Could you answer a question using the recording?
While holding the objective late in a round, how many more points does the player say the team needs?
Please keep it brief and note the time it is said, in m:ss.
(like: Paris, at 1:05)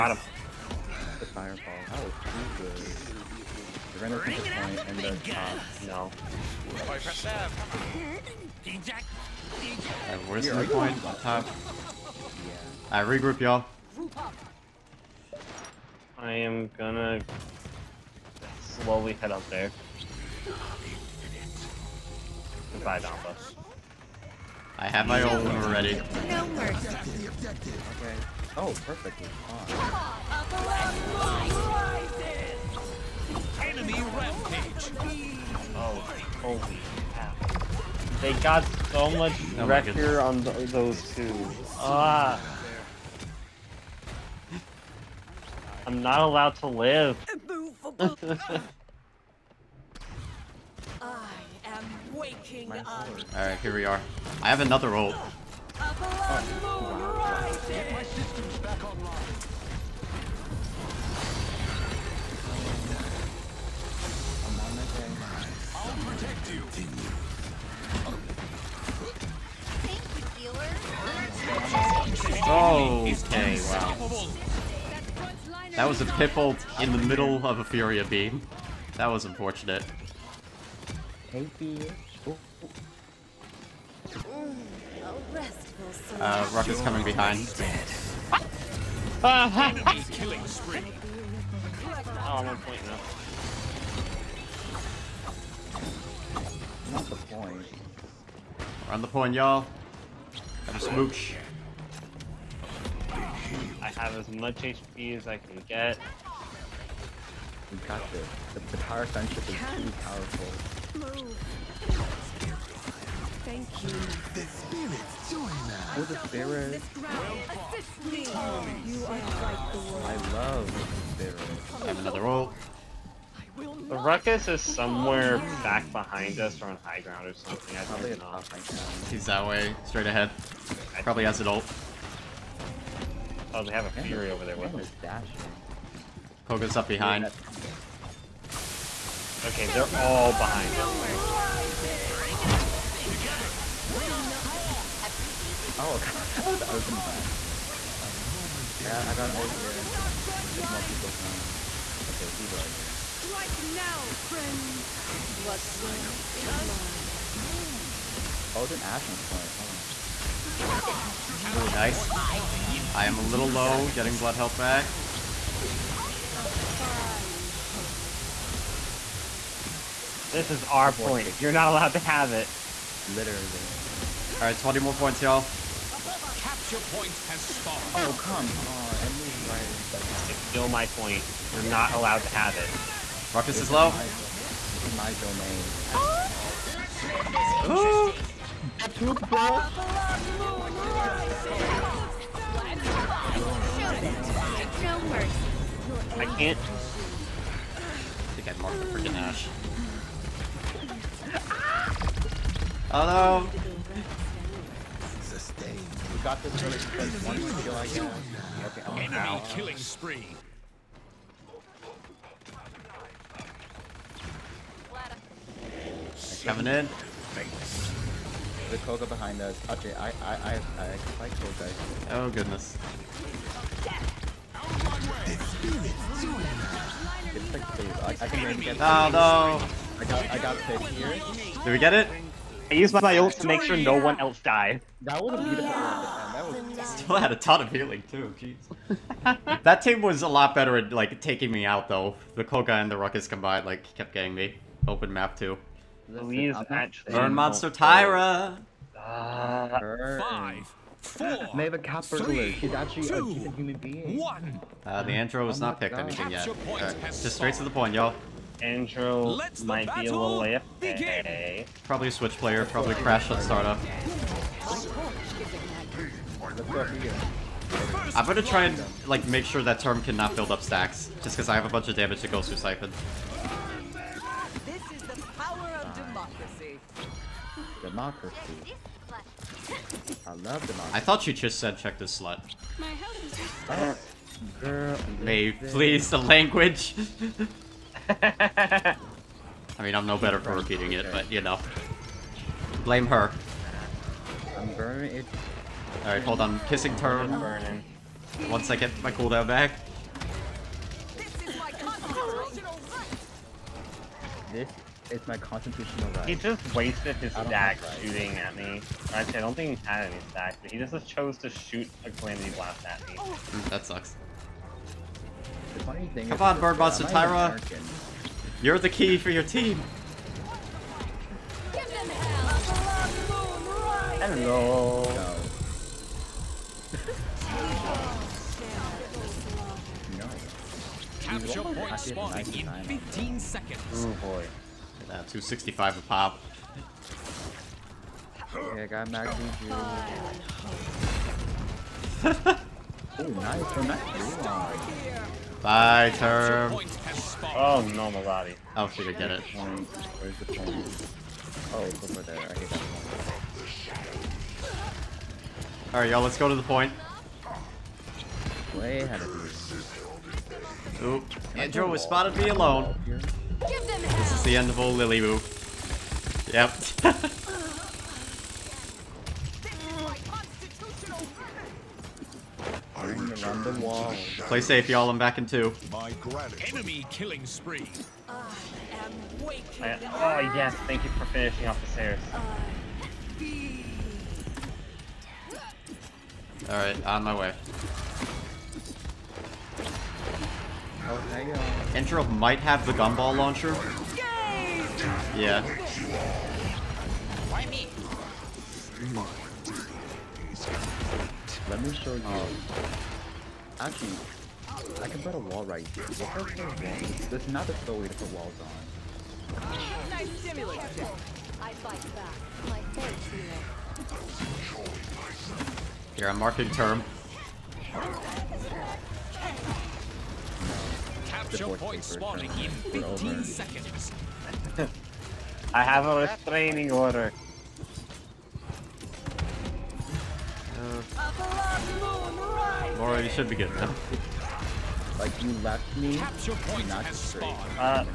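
20, at 2:54.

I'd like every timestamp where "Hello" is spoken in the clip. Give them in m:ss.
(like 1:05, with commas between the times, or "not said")
3:22, 5:24.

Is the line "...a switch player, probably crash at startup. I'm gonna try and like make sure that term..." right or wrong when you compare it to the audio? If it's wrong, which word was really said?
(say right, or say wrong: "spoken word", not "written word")
right.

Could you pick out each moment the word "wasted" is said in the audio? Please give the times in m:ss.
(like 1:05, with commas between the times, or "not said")
5:06.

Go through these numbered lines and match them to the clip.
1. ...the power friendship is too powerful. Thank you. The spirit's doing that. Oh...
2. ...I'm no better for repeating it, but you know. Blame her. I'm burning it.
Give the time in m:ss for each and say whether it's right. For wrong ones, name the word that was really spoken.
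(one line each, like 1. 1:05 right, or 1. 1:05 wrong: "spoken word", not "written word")
1. 1:48 right
2. 4:49 right.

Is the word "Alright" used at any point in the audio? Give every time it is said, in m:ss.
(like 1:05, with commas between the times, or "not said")
0:53, 2:54, 4:56, 5:55.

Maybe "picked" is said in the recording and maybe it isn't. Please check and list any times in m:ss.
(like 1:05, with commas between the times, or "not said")
3:50, 4:15.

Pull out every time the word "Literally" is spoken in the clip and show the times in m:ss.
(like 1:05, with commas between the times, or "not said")
2:53.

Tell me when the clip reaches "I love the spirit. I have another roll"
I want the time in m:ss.
2:00.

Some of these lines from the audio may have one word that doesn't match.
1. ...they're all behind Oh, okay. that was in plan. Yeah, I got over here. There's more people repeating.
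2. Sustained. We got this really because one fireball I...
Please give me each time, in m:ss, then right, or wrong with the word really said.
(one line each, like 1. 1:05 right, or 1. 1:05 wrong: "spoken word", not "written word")
1. 2:19 wrong: "coming", not "repeating"
2. 3:25 wrong: "skill", not "fireball".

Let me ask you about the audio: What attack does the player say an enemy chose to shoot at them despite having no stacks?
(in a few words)
Calamity Blast.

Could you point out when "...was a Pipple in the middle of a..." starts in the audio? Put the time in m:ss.
1:15.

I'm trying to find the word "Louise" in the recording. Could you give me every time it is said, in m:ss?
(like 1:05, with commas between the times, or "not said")
4:06.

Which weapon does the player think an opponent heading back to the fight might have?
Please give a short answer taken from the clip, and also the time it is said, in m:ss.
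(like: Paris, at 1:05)
gumball launcher, at 6:32.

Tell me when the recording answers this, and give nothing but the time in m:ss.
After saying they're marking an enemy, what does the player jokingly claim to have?
7:06.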